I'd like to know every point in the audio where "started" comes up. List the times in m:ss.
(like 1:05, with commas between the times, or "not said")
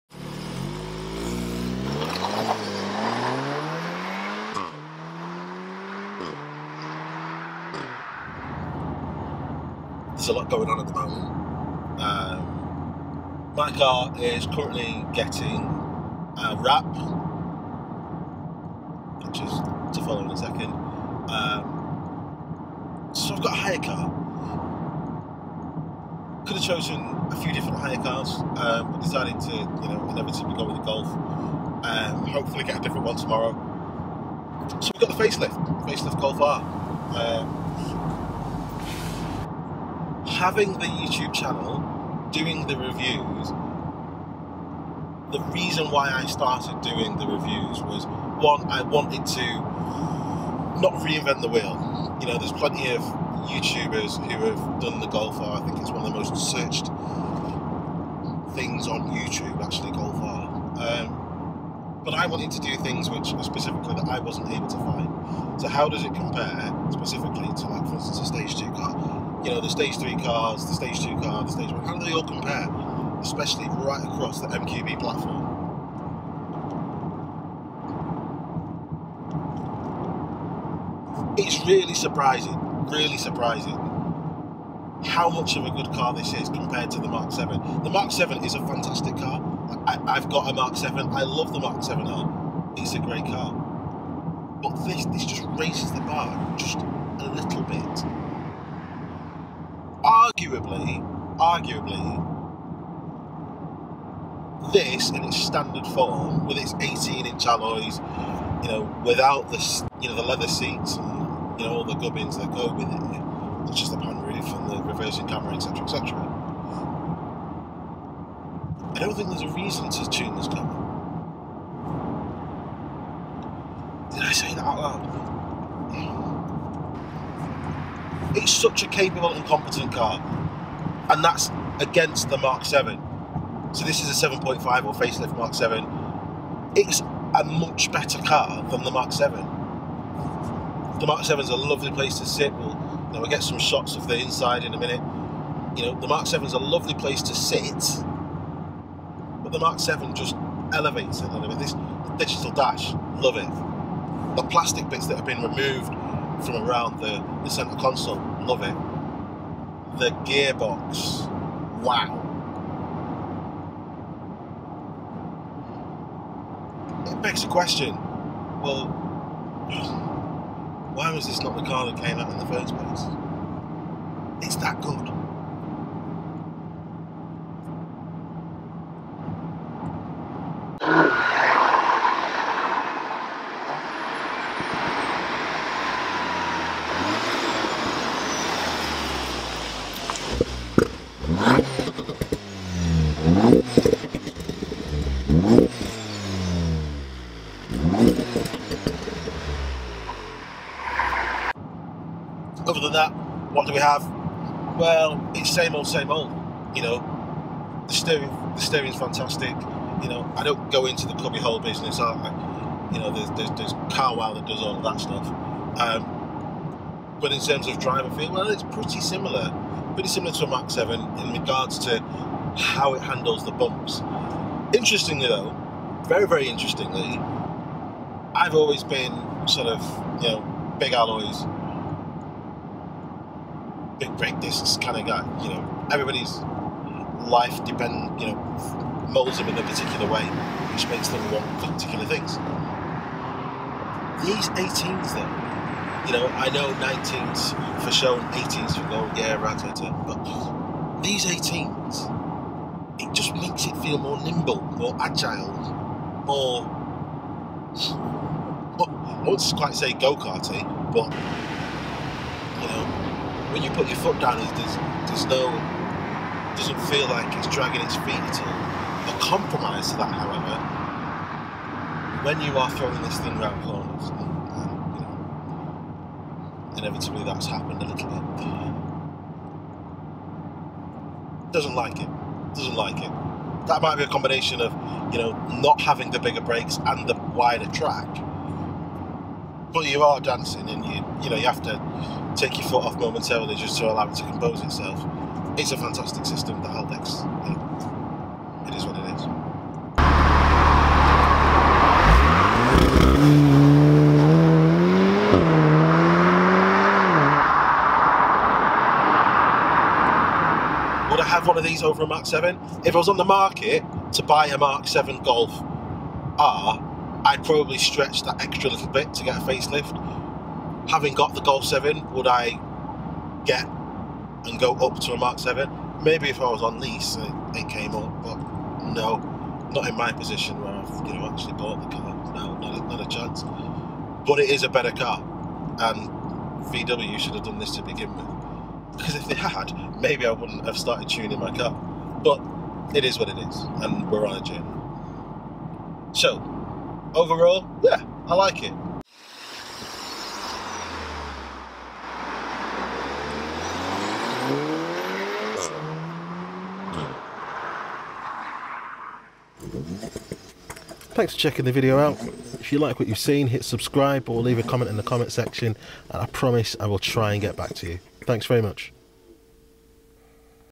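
0:46, 5:40.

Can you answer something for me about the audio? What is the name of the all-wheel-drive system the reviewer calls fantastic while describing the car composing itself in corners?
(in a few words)
Haldex.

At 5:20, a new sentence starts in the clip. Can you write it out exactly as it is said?
Having got the Golf 7, would I get and go up to a Mark 7?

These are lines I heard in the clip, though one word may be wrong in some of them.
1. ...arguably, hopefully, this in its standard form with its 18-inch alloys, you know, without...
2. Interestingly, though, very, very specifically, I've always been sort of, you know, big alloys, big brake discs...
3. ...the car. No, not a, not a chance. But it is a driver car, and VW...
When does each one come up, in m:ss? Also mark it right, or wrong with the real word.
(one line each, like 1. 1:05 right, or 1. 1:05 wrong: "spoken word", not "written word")
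1. 1:40 wrong: "arguably", not "hopefully"
2. 3:44 wrong: "interestingly", not "specifically"
3. 5:31 wrong: "better", not "driver".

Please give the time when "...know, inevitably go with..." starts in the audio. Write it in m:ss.
0:29.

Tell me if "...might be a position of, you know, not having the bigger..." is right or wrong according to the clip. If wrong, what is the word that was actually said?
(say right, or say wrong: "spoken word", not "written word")
wrong: "combination", not "position".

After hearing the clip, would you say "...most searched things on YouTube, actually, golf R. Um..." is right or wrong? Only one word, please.
right.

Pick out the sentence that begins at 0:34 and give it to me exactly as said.
So we've got the facelift, facelift Golf R.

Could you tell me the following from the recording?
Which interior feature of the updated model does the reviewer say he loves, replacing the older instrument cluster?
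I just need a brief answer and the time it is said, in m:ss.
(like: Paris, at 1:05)
digital dash, at 2:32.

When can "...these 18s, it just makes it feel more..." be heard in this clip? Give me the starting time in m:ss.
4:11.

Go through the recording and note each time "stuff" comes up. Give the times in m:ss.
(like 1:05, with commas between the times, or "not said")
3:34.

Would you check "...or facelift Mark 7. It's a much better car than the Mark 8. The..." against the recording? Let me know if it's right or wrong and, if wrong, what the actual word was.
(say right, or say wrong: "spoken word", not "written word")
wrong: "7", not "8".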